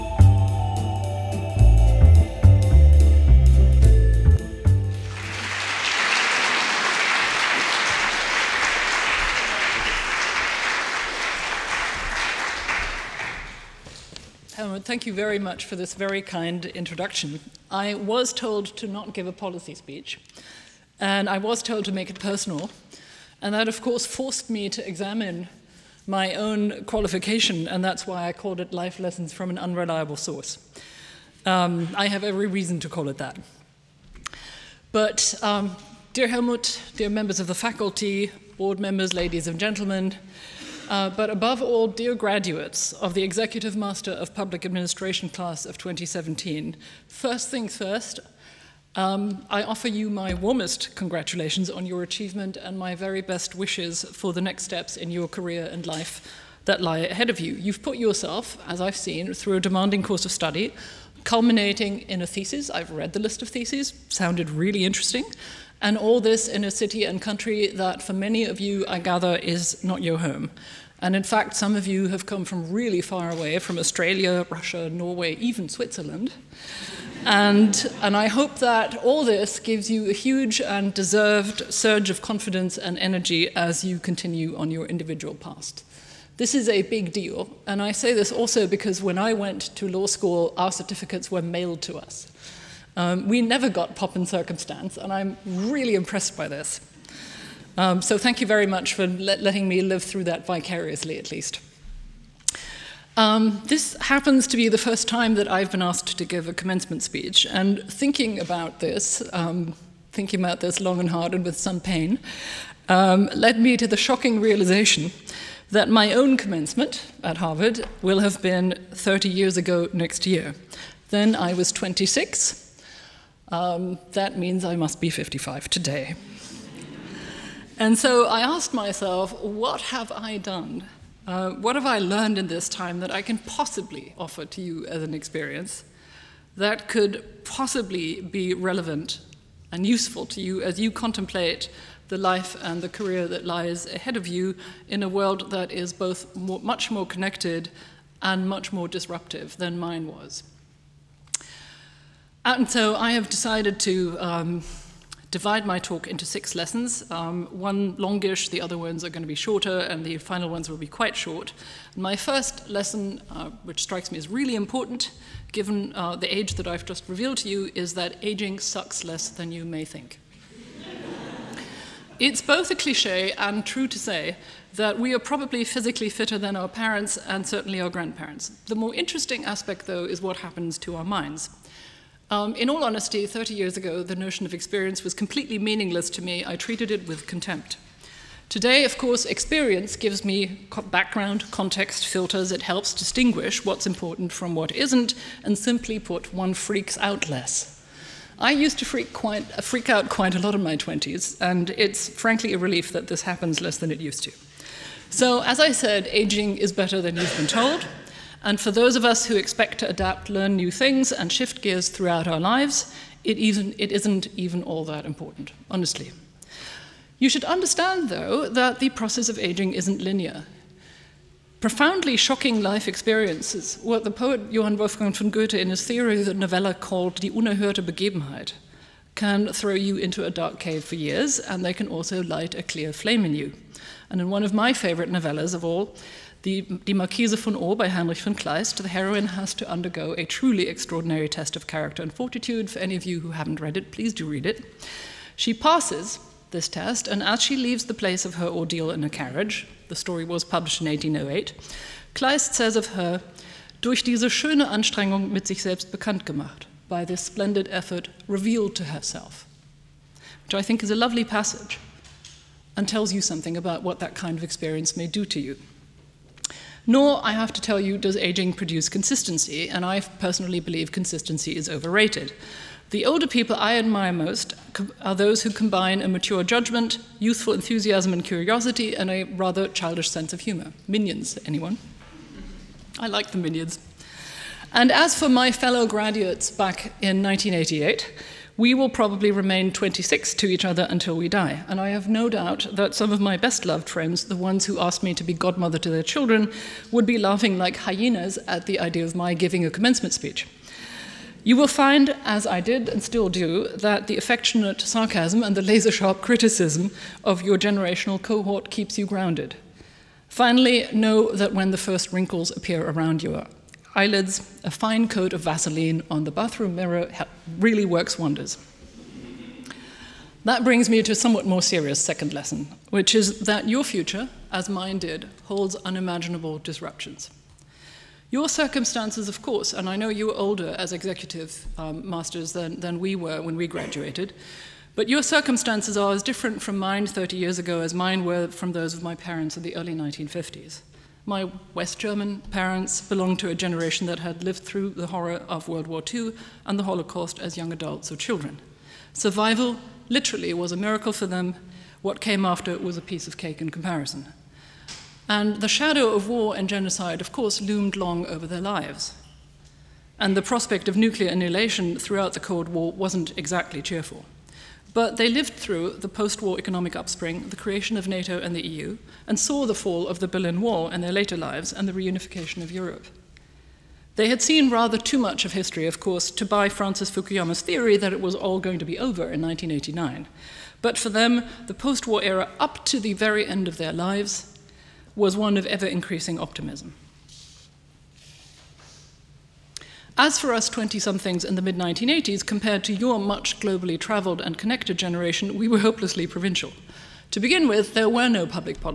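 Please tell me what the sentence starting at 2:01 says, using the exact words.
Then I was 26, um, that means I must be 55 today.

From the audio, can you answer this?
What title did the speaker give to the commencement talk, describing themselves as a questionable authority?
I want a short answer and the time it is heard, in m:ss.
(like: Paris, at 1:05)
Life Lessons from an Unreliable Source, at 0:28.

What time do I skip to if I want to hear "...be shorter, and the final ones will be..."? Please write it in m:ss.
2:39.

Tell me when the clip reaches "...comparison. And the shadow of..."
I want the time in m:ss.
5:53.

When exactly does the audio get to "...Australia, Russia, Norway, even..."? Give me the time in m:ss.
1:13.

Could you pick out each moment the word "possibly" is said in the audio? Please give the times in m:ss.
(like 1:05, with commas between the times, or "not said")
2:13, 2:17.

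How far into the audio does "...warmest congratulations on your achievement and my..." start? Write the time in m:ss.
0:50.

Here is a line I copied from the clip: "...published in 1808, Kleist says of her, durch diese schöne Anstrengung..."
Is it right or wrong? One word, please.
right.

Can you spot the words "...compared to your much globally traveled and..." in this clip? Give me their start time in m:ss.
6:32.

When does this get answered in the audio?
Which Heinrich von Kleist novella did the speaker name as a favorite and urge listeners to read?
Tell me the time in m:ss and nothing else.
3:56.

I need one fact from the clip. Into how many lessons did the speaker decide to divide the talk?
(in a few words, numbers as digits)
6.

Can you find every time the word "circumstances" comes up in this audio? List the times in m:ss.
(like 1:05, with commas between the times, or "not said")
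1:34, 5:28, 5:35.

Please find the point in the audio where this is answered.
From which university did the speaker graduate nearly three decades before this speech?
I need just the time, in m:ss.
1:57.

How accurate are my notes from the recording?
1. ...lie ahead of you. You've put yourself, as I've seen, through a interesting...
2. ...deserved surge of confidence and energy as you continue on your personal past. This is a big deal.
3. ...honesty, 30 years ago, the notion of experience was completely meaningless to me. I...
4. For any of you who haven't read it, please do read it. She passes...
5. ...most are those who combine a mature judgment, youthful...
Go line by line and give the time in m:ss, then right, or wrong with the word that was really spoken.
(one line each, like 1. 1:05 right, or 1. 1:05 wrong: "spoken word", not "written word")
1. 0:56 wrong: "demanding", not "interesting"
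2. 1:20 wrong: "individual", not "personal"
3. 3:02 right
4. 4:02 right
5. 4:34 right.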